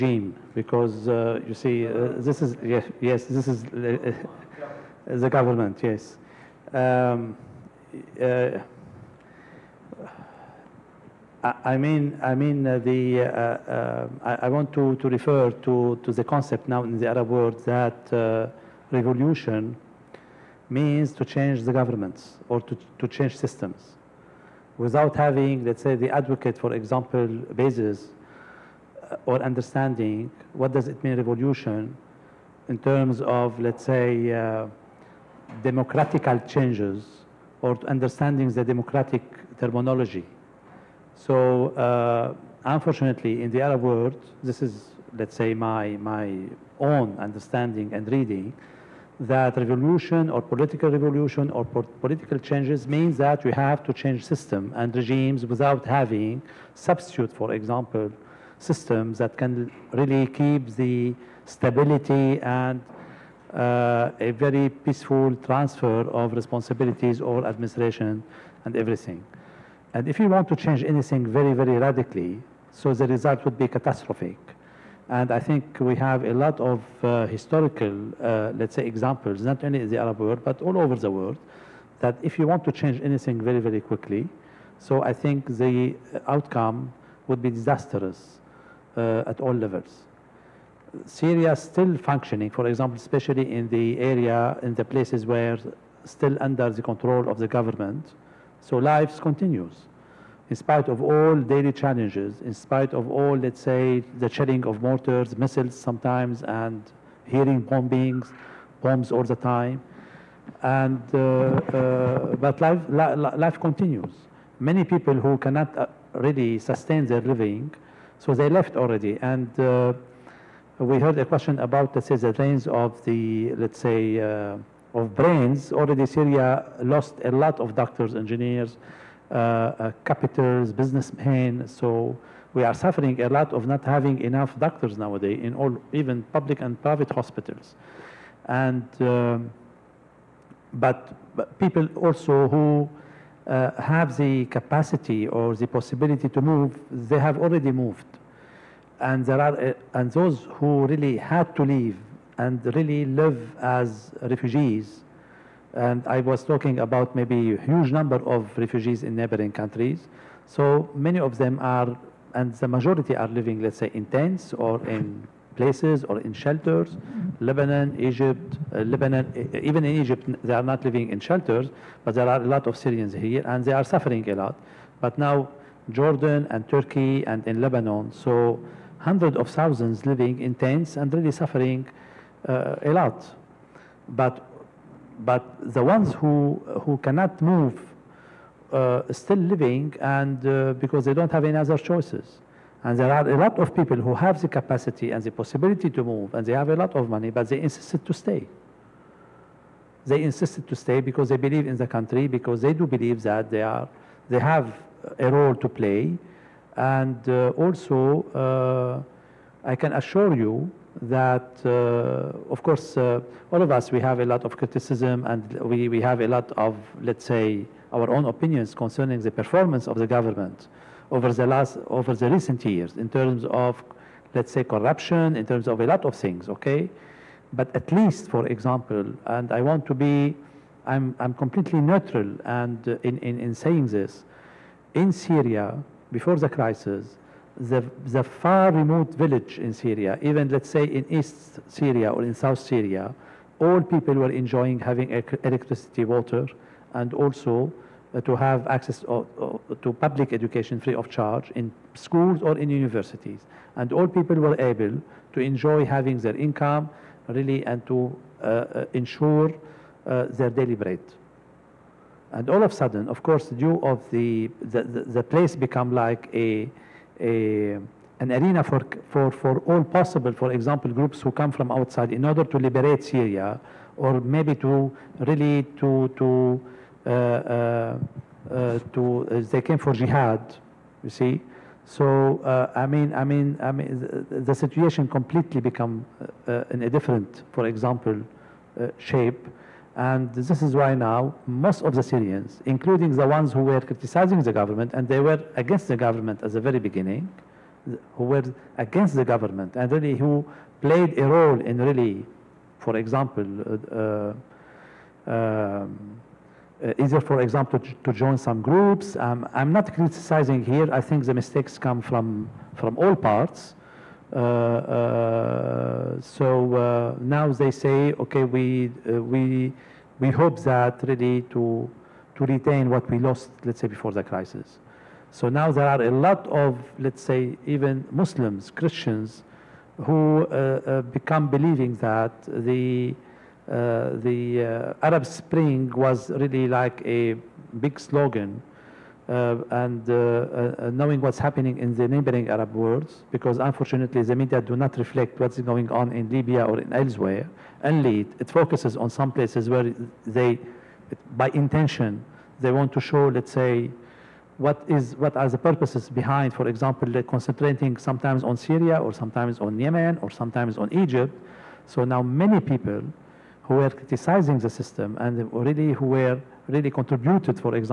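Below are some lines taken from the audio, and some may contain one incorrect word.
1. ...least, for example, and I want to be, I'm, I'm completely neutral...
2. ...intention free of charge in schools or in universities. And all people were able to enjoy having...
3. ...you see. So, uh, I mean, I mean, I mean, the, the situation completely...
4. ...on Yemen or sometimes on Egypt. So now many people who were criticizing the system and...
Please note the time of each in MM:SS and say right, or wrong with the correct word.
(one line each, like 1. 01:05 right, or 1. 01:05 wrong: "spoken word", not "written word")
1. 03:47 right
2. 04:10 wrong: "education", not "intention"
3. 04:41 right
4. 05:59 right.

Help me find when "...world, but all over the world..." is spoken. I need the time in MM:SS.
01:20.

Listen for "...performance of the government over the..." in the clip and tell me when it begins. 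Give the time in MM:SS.
03:39.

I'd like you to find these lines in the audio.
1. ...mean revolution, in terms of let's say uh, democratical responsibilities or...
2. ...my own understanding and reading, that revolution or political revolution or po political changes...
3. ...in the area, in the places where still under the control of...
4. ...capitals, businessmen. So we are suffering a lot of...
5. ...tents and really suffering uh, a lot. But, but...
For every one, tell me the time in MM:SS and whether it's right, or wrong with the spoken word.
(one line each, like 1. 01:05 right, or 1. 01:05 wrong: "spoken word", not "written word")
1. 00:31 wrong: "changes", not "responsibilities"
2. 00:45 right
3. 01:33 right
4. 02:10 right
5. 03:00 right.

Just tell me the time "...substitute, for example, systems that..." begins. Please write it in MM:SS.
00:56.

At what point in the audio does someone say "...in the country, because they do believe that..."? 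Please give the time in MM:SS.
03:21.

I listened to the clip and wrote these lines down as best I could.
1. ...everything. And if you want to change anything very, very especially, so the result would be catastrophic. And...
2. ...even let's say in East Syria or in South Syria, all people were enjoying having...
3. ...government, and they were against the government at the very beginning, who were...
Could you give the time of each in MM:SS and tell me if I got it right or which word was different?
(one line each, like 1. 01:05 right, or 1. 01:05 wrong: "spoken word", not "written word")
1. 01:08 wrong: "radically", not "especially"
2. 04:00 right
3. 04:54 right.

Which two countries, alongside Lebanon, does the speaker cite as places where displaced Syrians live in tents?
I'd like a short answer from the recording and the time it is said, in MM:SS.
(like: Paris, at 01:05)
Jordan and Turkey, at 02:55.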